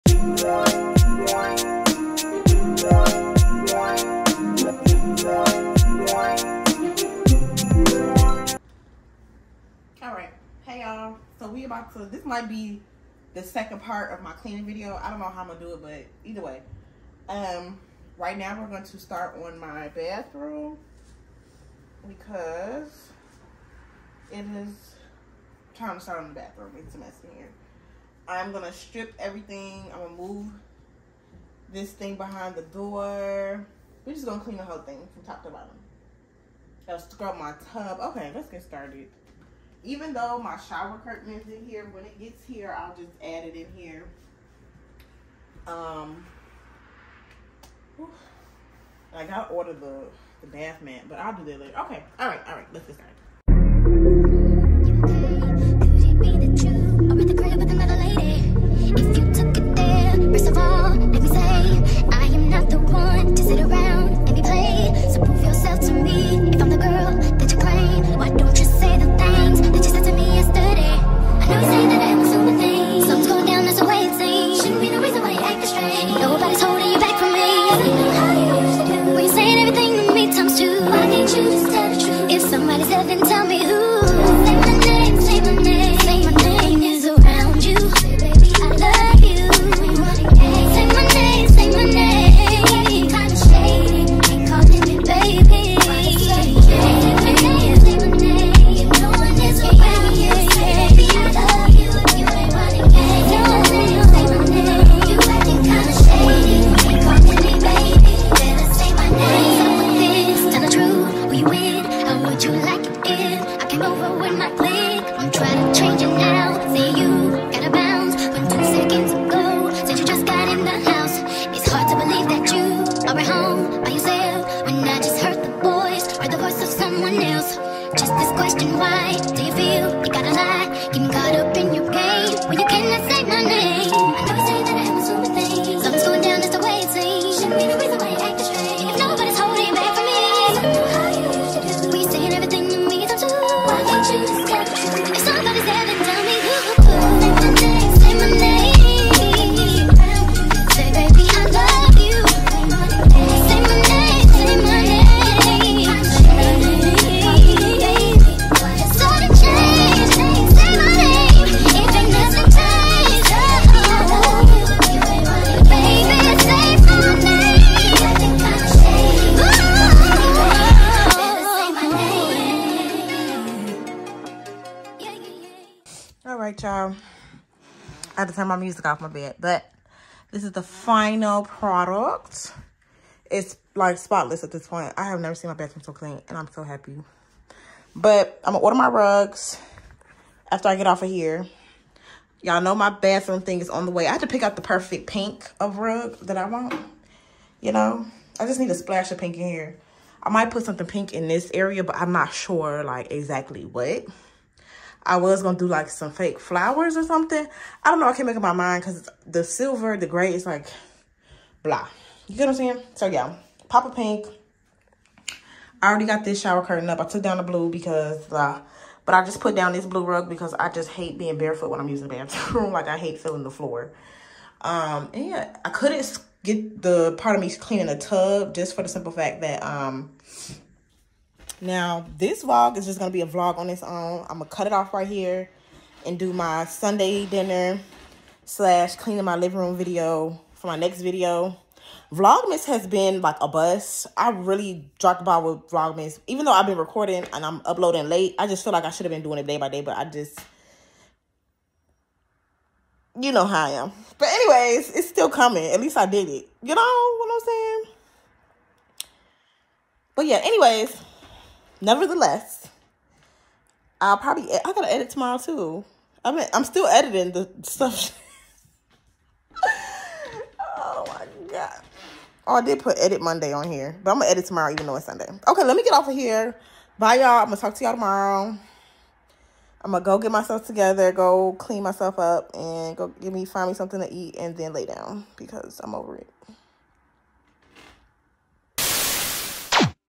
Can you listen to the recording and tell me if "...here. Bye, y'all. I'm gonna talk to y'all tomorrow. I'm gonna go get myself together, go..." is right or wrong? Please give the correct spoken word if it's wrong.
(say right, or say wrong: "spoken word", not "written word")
right.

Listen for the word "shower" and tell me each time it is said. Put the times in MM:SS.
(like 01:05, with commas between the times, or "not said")
00:40, 03:36.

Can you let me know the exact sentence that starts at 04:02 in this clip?
Vlogmas has been like a bust.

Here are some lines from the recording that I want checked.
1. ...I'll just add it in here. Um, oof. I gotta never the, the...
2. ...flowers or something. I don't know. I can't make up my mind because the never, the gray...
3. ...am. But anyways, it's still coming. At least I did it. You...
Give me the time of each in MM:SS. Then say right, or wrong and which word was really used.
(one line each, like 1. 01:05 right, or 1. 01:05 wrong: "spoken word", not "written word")
1. 00:42 wrong: "order", not "never"
2. 03:26 wrong: "silver", not "never"
3. 04:13 right.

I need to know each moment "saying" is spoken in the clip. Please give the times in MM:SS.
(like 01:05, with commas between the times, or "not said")
03:32, 04:17.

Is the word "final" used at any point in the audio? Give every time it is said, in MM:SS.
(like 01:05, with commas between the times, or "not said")
03:00.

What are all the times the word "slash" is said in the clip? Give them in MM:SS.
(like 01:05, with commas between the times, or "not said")
03:58.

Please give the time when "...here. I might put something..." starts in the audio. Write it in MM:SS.
03:19.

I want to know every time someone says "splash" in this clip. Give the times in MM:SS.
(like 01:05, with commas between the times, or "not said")
03:18.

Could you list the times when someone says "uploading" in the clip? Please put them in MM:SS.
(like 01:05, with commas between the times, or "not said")
04:07.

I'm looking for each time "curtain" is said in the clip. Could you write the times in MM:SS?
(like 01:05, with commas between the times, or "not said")
00:41, 03:36.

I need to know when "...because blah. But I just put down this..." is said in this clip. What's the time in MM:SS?
03:37.